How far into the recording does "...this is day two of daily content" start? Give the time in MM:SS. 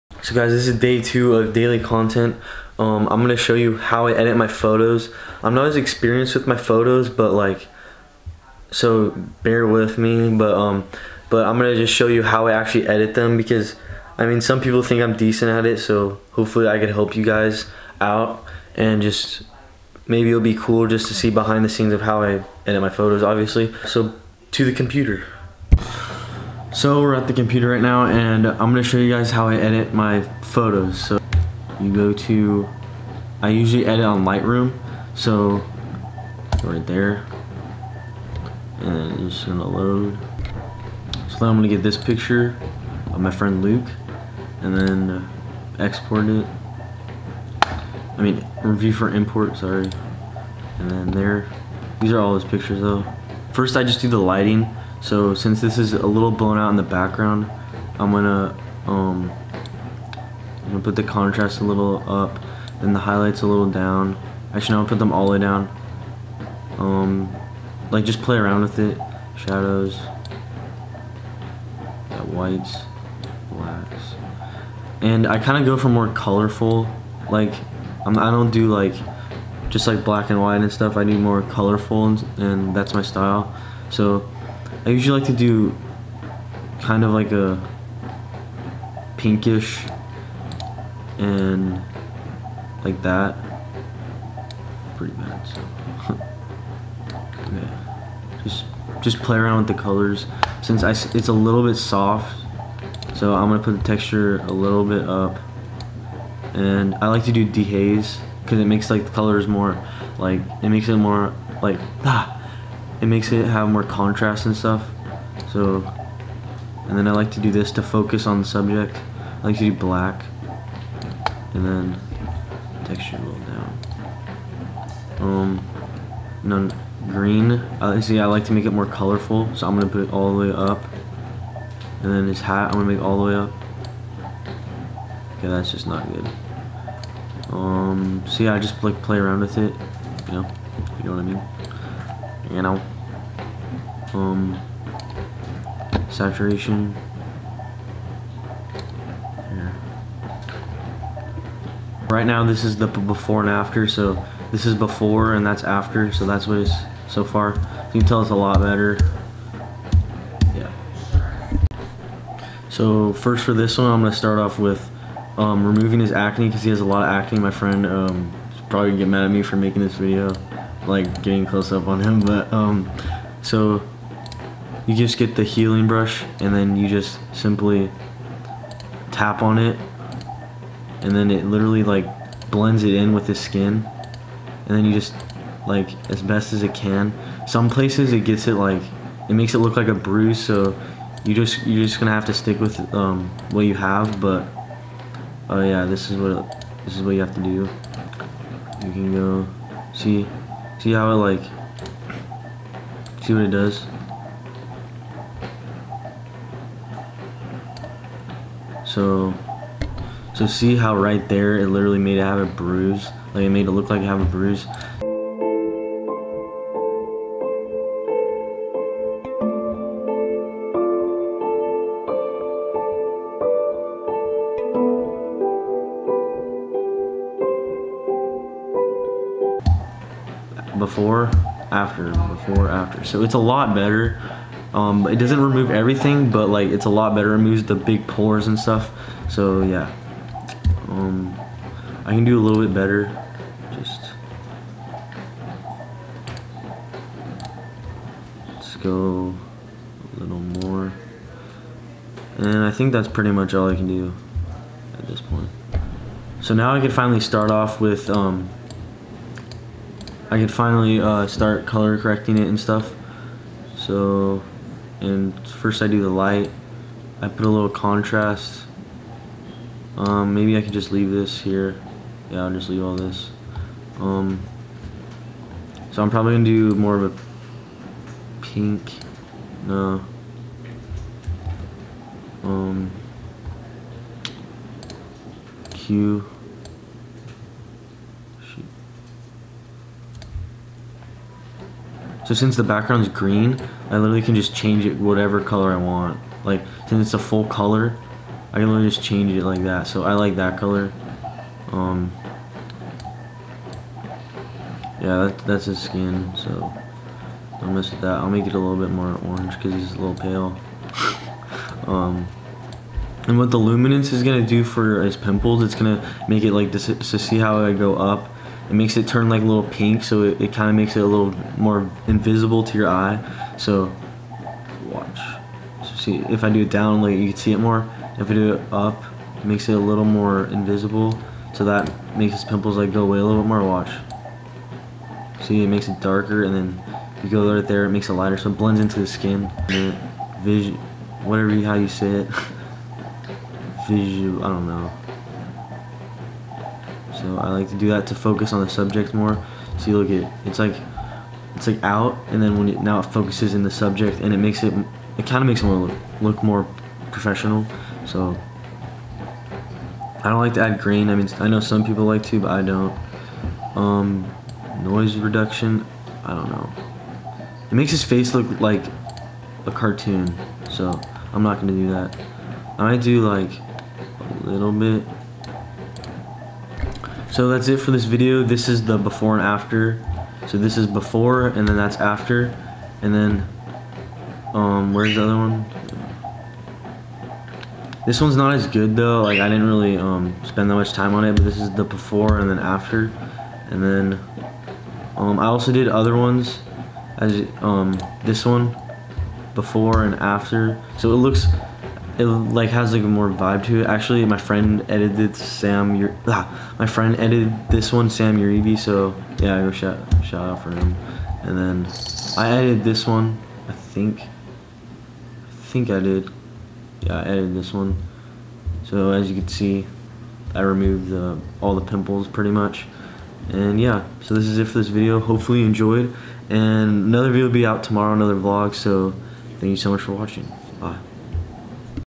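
00:00.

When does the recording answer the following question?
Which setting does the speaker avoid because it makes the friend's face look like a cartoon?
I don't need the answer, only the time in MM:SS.
06:04.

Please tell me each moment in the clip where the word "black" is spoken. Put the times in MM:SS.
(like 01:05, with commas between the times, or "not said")
01:13, 01:20, 01:59.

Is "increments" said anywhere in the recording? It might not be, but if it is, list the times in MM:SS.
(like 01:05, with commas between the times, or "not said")
not said.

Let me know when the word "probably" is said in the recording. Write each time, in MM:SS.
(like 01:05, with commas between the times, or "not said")
02:48, 04:36.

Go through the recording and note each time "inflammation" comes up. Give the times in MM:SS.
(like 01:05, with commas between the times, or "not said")
not said.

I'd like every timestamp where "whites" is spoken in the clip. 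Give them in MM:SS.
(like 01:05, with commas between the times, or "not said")
01:12, 01:20.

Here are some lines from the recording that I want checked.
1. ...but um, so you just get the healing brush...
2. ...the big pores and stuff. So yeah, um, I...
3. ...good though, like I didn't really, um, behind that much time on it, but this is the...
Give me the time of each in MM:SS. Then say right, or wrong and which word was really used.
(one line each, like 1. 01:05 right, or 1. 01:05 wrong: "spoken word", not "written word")
1. 02:52 right
2. 03:57 right
3. 06:28 wrong: "spend", not "behind".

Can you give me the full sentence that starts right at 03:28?
So, so see how right there it literally made it have a bruise?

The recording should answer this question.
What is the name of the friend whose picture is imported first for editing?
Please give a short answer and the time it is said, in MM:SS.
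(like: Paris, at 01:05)
Luke, at 00:43.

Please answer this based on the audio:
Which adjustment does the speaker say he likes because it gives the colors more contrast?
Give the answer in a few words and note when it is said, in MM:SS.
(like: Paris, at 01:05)
dehaze, at 01:47.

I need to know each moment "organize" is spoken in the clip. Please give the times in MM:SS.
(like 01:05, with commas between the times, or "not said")
not said.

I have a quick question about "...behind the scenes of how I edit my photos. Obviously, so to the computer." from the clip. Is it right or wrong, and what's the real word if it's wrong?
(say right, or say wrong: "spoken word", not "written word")
right.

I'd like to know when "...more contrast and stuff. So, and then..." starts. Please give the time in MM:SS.
01:53.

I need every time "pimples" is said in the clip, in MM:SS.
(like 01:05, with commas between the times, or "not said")
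05:15, 05:32, 07:01.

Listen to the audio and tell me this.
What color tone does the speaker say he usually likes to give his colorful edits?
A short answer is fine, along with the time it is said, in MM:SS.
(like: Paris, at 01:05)
pinkish, at 01:29.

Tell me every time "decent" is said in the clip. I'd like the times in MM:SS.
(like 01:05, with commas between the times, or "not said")
00:15.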